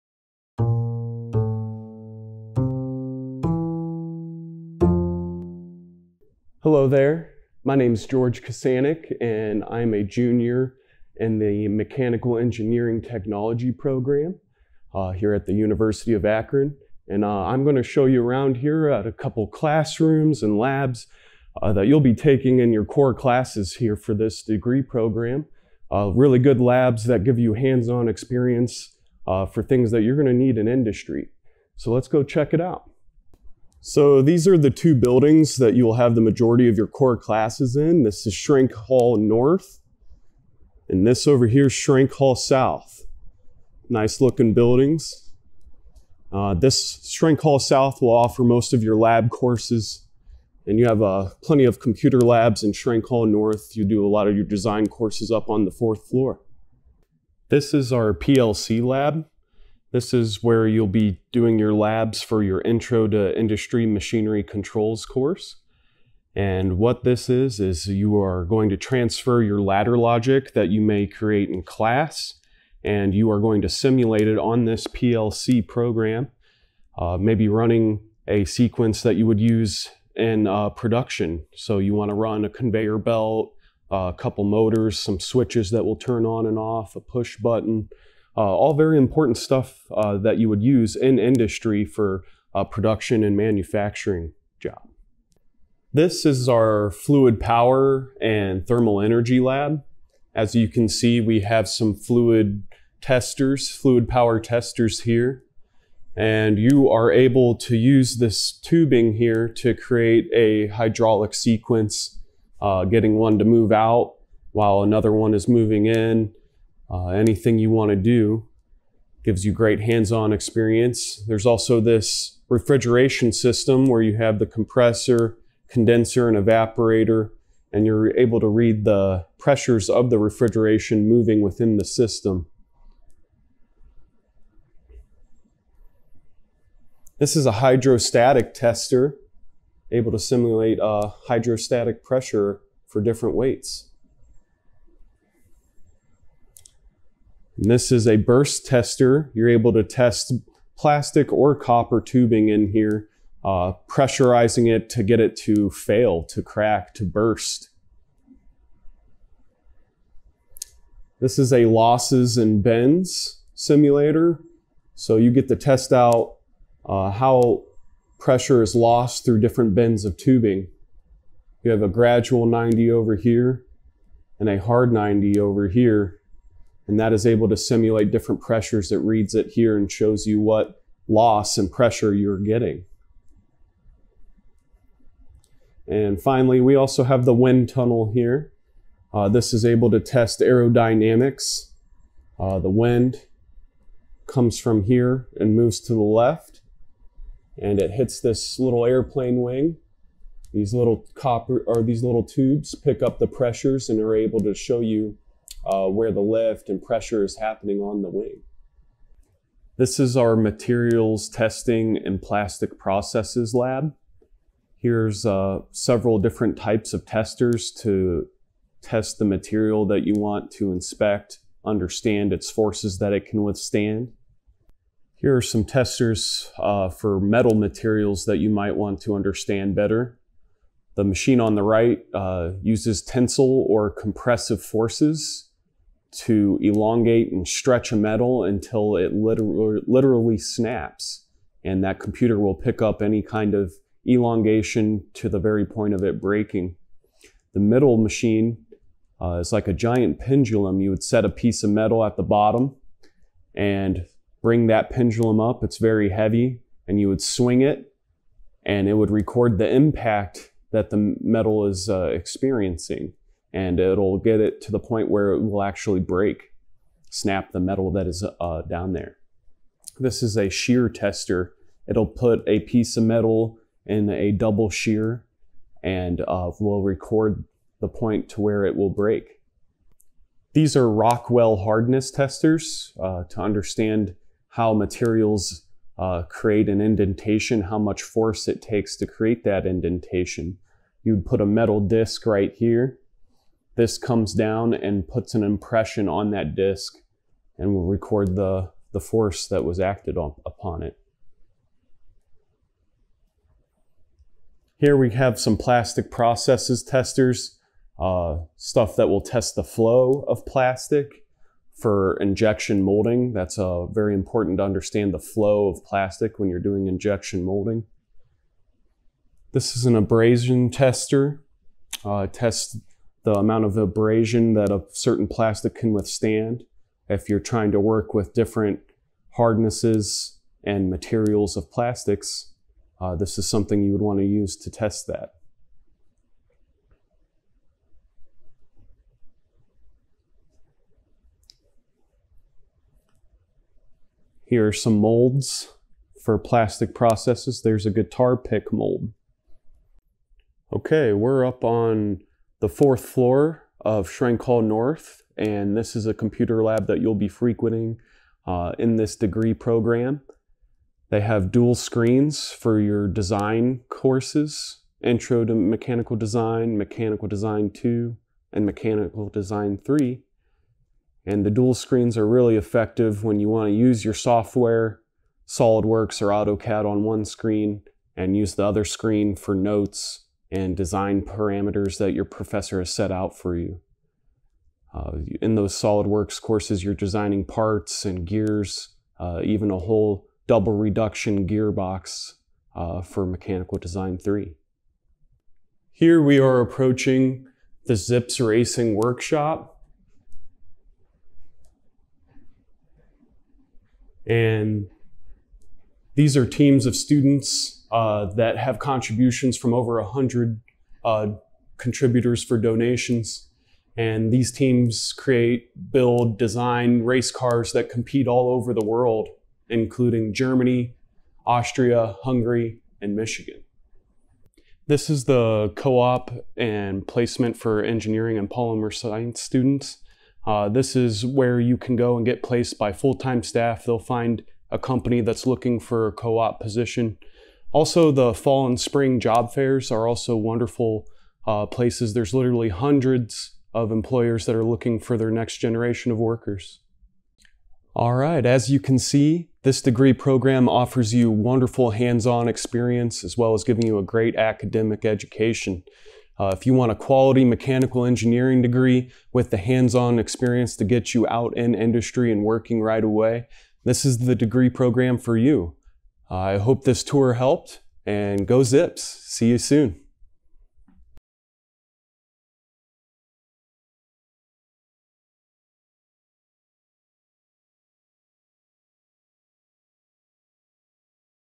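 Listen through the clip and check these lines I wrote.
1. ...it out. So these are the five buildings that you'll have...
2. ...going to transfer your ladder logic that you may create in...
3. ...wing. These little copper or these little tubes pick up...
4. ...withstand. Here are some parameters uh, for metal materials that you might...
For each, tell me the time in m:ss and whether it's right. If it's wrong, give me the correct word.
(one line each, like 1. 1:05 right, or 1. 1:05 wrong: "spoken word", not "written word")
1. 0:32 wrong: "two", not "five"
2. 1:08 right
3. 3:19 right
4. 3:43 wrong: "testers", not "parameters".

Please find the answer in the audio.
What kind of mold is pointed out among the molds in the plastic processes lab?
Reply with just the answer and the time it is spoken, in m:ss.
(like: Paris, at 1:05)
Guitar pick mold, at 5:47.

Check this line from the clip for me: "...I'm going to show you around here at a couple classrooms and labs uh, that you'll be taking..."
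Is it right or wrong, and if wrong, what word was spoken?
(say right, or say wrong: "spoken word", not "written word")
right.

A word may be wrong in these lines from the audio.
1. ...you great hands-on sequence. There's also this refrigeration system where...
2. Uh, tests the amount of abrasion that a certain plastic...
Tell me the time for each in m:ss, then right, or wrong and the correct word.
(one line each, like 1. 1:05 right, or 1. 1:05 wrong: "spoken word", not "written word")
1. 1:59 wrong: "experience", not "sequence"
2. 5:22 right.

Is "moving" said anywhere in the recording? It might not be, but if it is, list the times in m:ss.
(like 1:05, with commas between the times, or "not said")
1:55, 2:11.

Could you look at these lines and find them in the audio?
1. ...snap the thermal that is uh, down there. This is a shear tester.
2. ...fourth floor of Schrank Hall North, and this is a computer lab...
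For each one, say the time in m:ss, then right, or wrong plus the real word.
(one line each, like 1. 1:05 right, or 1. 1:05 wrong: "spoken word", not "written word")
1. 4:27 wrong: "metal", not "thermal"
2. 5:52 right.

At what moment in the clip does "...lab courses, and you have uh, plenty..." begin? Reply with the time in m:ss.
0:48.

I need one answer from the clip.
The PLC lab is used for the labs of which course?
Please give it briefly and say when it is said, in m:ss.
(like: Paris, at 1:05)
Intro to Industry Machinery Controls, at 1:02.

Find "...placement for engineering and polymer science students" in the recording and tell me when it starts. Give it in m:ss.
7:07.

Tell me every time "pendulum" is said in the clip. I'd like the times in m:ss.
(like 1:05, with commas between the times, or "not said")
4:10, 4:14.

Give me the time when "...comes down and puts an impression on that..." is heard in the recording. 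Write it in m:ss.
4:53.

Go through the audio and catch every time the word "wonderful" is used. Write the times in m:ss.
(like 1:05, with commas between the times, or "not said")
7:20, 7:31.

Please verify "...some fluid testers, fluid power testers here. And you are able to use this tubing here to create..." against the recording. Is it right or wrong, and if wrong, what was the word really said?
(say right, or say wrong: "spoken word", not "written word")
right.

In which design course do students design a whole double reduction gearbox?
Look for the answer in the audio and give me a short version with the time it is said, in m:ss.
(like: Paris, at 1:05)
Mechanical Design 3, at 6:29.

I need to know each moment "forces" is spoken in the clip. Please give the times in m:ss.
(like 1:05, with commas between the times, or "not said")
3:42, 3:54, 4:48, 4:58.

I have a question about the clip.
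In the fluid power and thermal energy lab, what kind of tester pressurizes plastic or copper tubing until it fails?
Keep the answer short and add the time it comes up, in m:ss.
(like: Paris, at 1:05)
Burst tester, at 2:28.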